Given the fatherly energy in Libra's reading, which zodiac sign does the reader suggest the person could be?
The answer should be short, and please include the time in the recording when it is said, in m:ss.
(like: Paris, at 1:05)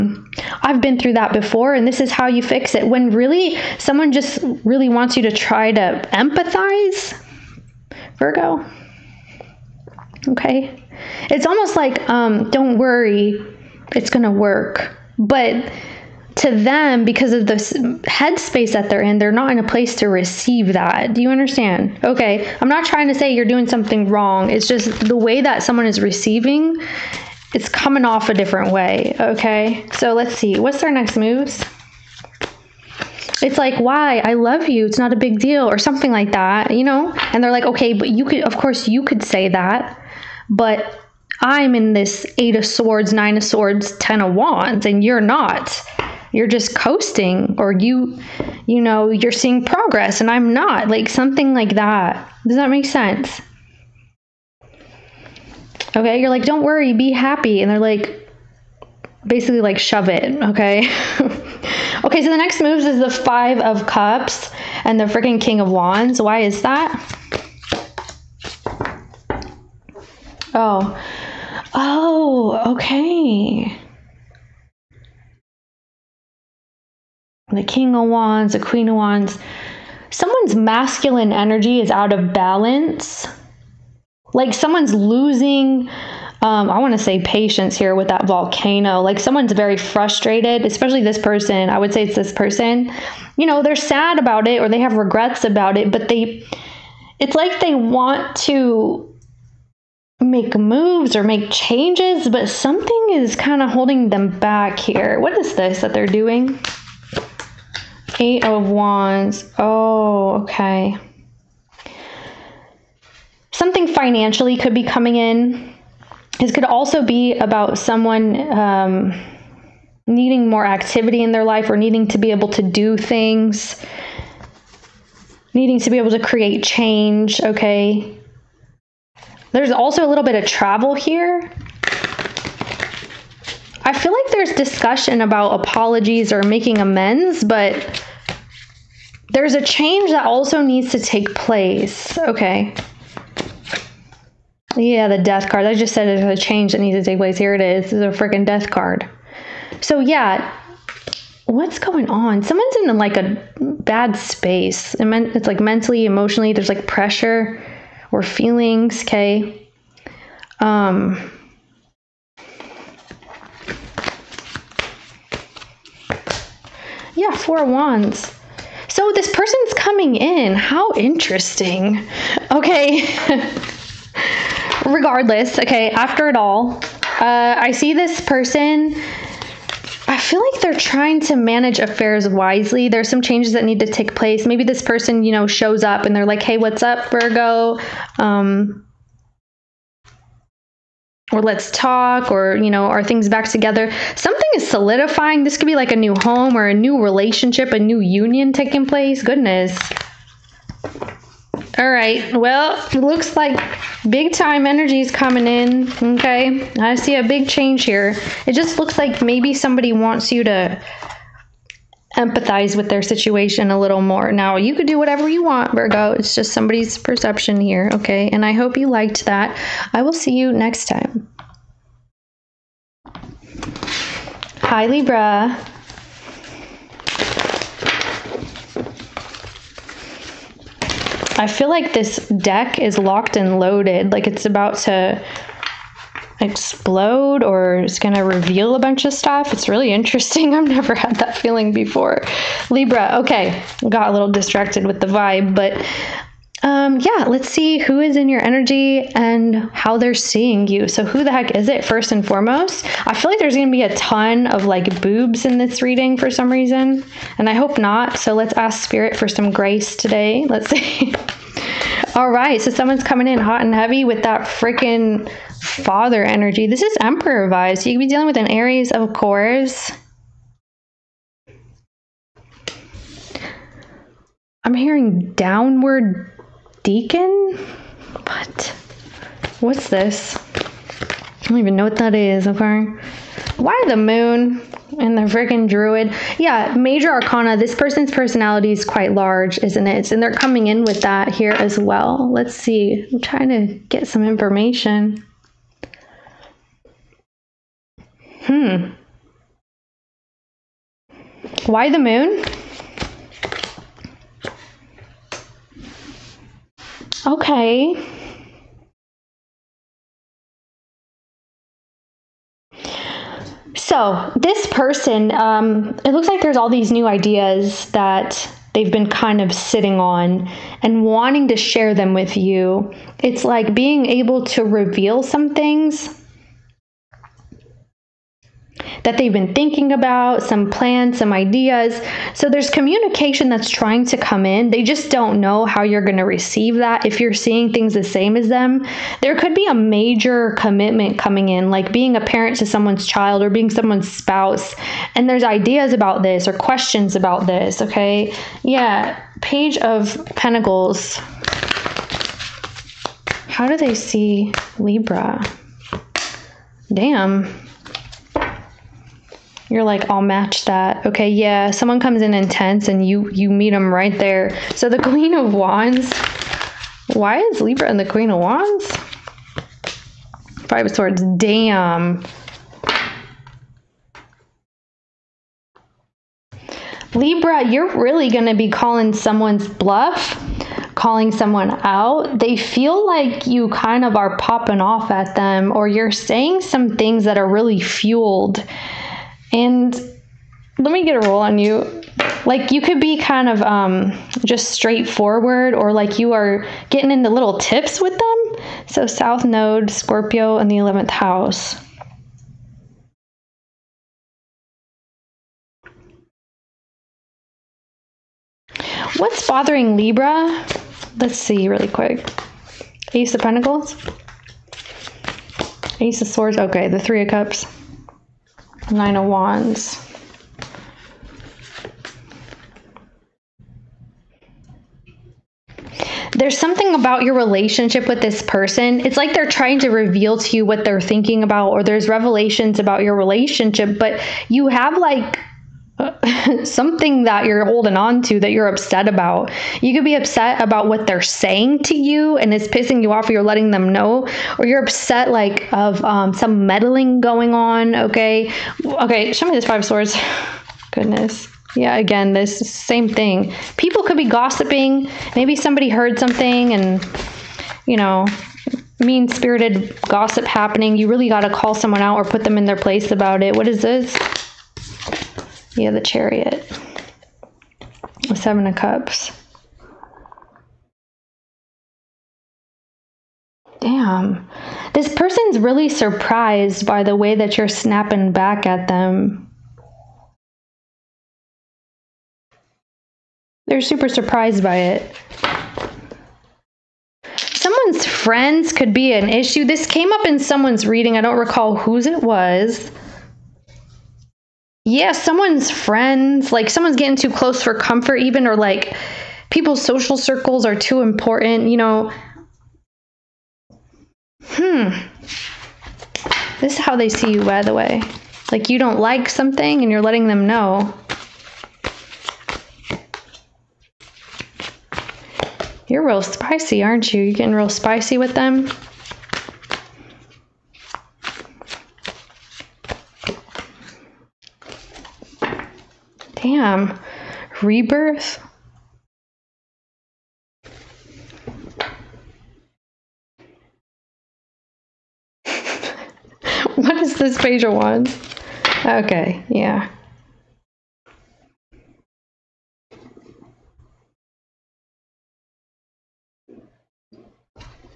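Aries, at 4:28.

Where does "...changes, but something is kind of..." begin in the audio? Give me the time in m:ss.
1:41.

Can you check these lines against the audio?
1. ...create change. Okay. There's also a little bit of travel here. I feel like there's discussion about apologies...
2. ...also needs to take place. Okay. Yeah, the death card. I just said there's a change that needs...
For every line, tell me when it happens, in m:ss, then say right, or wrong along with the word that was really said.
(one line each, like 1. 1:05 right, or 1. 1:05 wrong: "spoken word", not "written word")
1. 2:06 right
2. 2:20 right.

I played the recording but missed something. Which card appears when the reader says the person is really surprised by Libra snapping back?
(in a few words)
The Chariot.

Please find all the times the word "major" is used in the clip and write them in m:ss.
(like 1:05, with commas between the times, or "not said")
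4:46, 5:39.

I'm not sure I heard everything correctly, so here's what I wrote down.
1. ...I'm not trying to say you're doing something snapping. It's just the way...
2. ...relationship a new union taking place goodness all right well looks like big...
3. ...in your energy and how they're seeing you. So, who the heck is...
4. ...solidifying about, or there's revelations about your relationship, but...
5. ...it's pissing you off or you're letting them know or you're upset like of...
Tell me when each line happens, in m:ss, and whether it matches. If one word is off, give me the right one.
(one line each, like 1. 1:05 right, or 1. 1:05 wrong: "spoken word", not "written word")
1. 0:22 wrong: "wrong", not "snapping"
2. 3:17 right
3. 4:08 right
4. 7:10 wrong: "thinking", not "solidifying"
5. 7:22 right.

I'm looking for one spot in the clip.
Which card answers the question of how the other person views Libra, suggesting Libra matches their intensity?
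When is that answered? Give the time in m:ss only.
5:49.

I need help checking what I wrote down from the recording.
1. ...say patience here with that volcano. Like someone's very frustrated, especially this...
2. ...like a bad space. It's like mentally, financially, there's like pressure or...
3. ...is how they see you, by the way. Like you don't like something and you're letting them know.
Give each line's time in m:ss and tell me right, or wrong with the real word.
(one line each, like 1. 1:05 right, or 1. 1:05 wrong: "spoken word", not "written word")
1. 1:26 right
2. 2:32 wrong: "emotionally", not "financially"
3. 8:26 right.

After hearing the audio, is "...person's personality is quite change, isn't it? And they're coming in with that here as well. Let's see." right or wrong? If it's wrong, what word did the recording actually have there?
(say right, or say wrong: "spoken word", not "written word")
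wrong: "large", not "change".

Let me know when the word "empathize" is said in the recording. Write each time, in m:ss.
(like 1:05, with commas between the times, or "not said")
0:06, 3:32.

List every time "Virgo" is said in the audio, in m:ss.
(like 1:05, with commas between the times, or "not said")
0:08, 3:07, 3:35.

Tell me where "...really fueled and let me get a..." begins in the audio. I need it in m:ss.
6:27.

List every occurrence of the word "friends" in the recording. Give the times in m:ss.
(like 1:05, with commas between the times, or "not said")
8:08, 8:15.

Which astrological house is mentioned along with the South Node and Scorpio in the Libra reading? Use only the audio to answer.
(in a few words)
eleventh house.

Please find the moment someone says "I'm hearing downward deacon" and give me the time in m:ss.
4:34.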